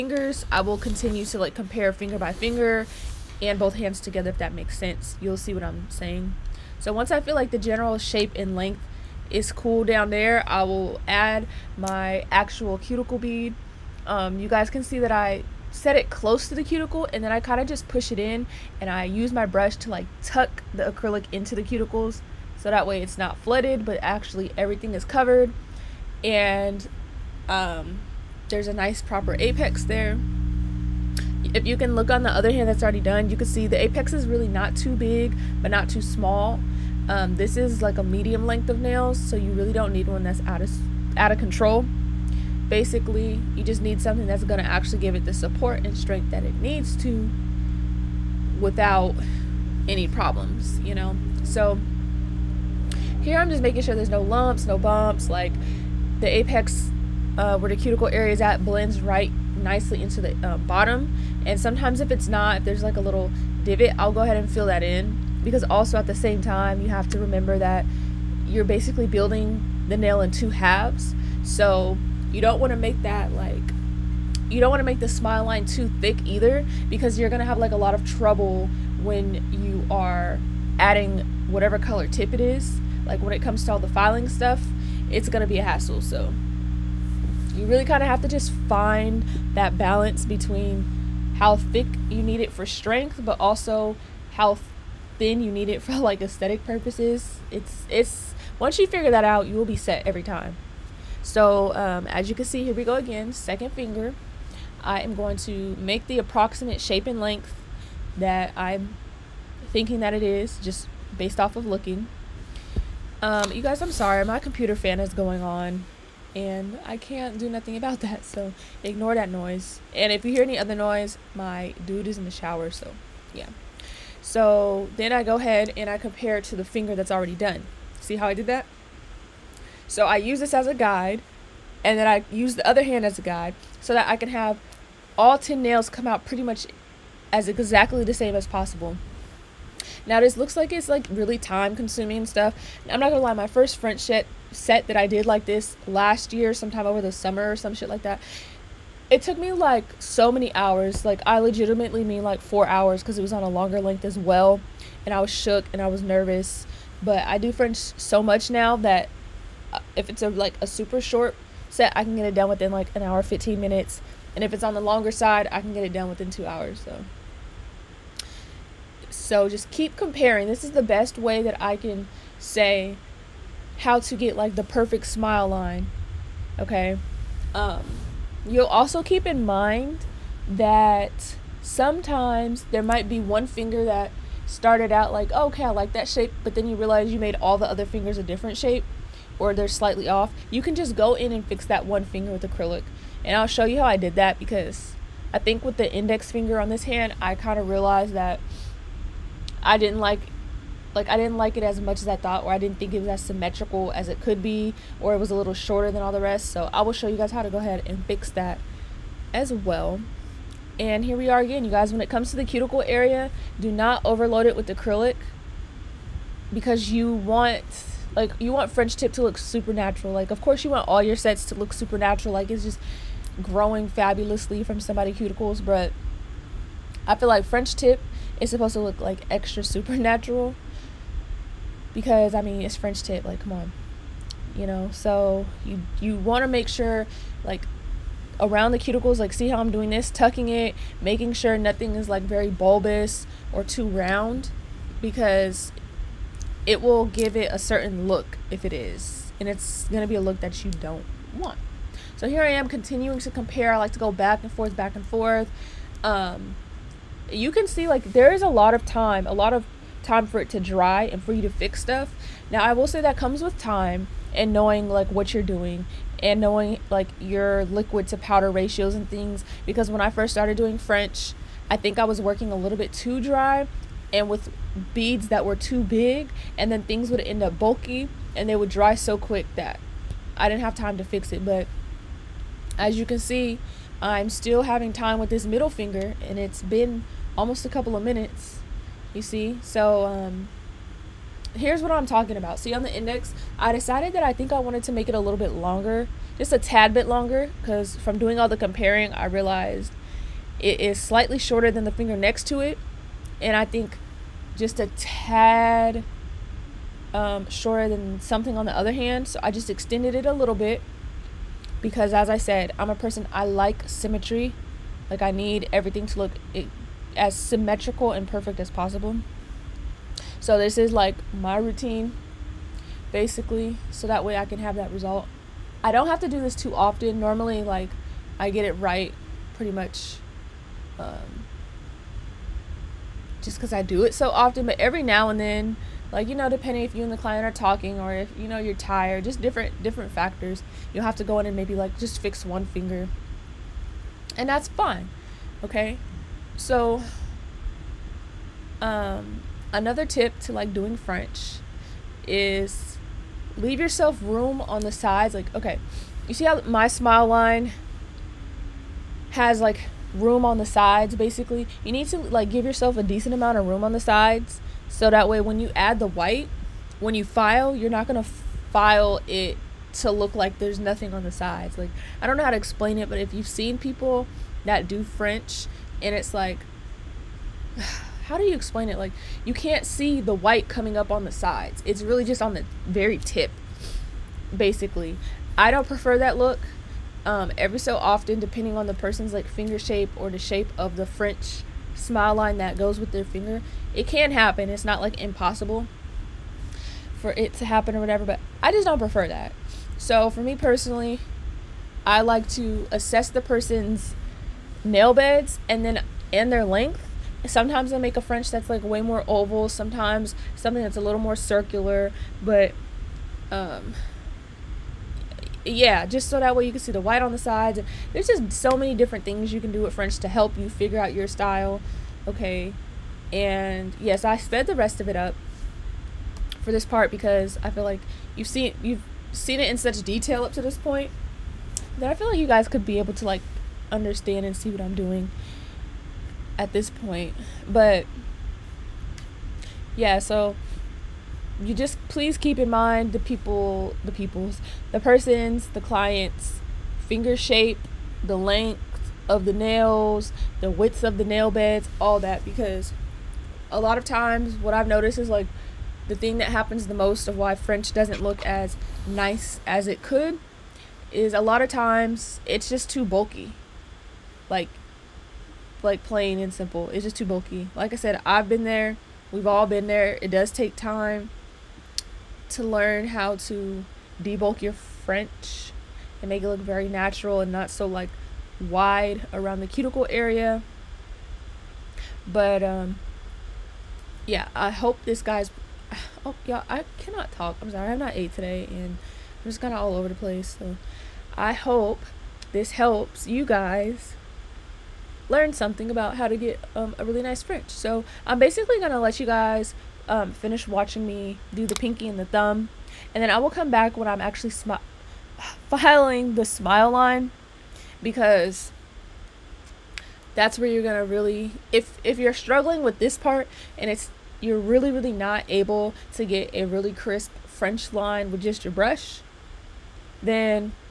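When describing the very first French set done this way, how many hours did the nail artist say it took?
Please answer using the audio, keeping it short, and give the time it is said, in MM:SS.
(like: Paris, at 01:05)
4 hours, at 02:32.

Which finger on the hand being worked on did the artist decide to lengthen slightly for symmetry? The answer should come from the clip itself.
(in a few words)
index finger.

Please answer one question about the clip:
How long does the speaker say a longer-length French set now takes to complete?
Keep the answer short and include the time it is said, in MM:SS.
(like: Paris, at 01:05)
2 hours, at 02:46.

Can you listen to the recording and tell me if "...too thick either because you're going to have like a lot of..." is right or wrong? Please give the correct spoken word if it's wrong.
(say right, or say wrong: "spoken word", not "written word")
right.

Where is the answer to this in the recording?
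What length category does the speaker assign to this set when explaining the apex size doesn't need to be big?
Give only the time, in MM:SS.
00:38.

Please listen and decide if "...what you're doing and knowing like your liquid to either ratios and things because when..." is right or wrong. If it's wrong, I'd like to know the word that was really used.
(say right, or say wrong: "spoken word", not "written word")
wrong: "powder", not "either".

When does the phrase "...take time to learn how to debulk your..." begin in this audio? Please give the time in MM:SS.
07:50.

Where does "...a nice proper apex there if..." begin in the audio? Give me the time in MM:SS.
00:28.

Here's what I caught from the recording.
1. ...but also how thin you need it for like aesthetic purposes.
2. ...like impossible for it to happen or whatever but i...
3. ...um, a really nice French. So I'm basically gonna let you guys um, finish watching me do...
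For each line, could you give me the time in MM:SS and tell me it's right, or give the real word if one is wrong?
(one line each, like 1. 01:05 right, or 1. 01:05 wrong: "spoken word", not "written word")
1. 01:33 right
2. 06:34 right
3. 08:16 right.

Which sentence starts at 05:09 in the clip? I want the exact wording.
So I just extended it a little bit because, as I said, I'm a person I like symmetry.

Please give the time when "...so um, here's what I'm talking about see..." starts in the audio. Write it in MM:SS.
04:49.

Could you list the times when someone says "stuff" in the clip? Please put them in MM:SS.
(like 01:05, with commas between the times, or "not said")
01:24, 02:22, 04:21.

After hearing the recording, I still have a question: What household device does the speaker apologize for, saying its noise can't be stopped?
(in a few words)
computer fan.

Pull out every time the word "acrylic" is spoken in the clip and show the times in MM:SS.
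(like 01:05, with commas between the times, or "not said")
00:20, 03:12, 03:34.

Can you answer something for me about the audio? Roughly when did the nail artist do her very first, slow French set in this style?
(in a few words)
last year.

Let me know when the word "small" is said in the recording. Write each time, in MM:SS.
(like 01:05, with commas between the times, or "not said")
00:36.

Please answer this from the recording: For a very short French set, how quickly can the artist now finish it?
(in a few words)
an hour, 15 minutes.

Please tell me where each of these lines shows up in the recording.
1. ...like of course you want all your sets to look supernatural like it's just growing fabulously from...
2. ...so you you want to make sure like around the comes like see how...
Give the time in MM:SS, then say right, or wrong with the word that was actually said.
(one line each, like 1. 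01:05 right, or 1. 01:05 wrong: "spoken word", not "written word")
1. 03:40 right
2. 03:54 wrong: "cuticles", not "comes".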